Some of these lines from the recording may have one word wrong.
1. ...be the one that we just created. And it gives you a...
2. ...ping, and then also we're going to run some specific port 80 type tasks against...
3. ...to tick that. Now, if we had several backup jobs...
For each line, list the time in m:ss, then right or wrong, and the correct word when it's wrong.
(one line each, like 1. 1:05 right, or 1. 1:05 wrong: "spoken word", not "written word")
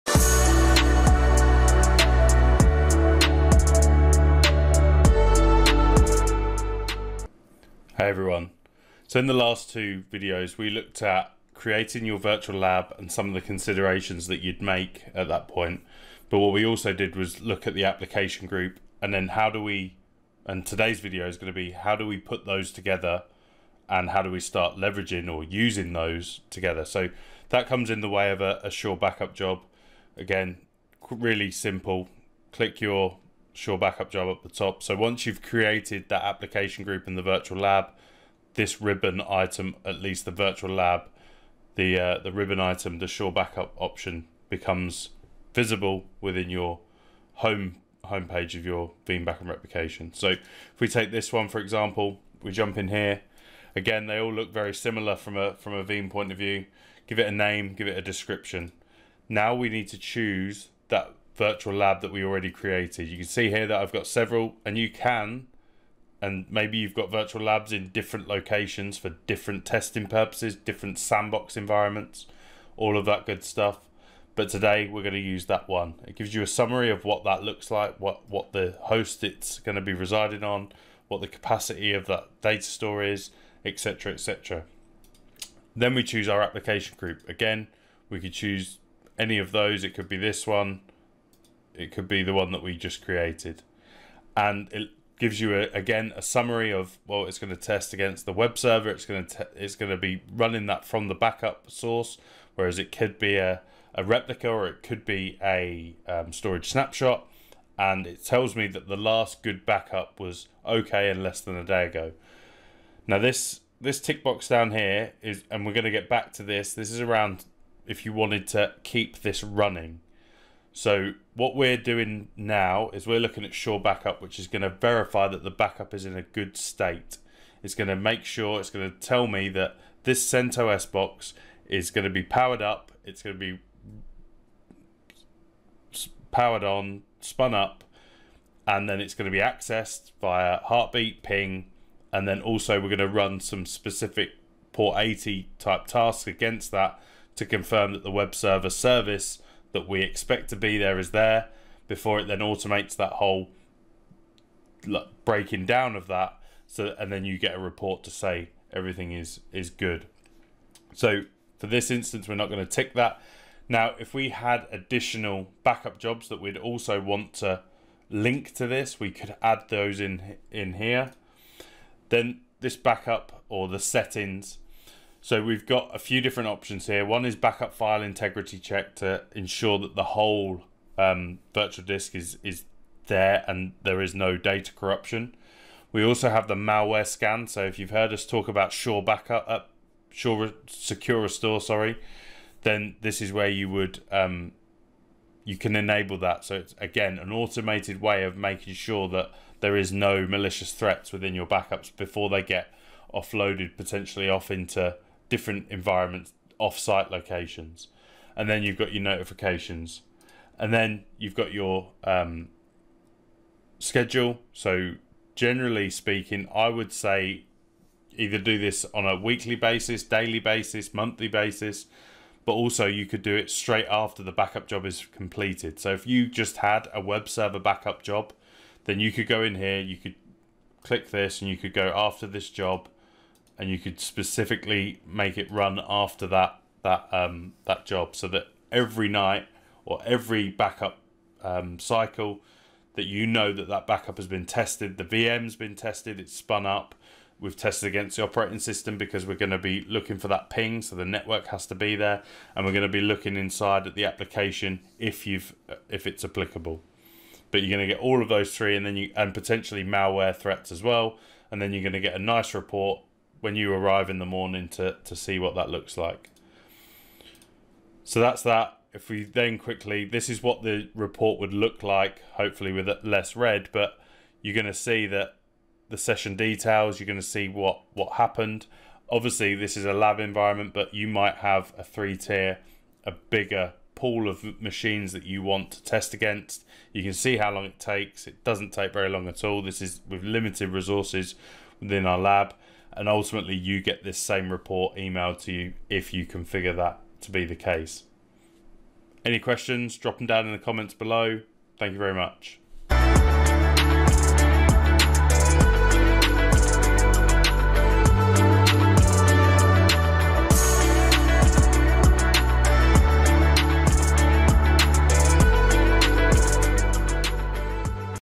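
1. 1:32 right
2. 2:21 right
3. 2:42 wrong: "additional", not "several".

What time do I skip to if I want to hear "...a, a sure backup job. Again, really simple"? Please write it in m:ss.
0:28.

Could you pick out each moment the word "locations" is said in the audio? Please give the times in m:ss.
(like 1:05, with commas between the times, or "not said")
1:08, 3:27.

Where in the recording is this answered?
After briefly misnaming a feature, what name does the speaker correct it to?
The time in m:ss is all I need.
3:10.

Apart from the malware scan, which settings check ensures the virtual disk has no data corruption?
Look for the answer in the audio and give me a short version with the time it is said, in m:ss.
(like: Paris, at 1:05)
Backup file integrity check, at 2:57.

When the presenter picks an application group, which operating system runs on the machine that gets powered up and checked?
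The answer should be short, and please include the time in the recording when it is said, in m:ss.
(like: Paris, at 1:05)
CentOS, at 2:10.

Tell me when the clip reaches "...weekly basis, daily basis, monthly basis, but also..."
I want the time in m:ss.
3:39.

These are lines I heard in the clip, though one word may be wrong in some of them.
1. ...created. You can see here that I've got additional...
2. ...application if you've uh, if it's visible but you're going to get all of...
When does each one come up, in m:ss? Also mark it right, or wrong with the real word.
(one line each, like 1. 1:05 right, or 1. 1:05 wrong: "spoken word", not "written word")
1. 1:02 wrong: "several", not "additional"
2. 4:14 wrong: "applicable", not "visible".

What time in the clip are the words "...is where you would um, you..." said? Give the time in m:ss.
3:13.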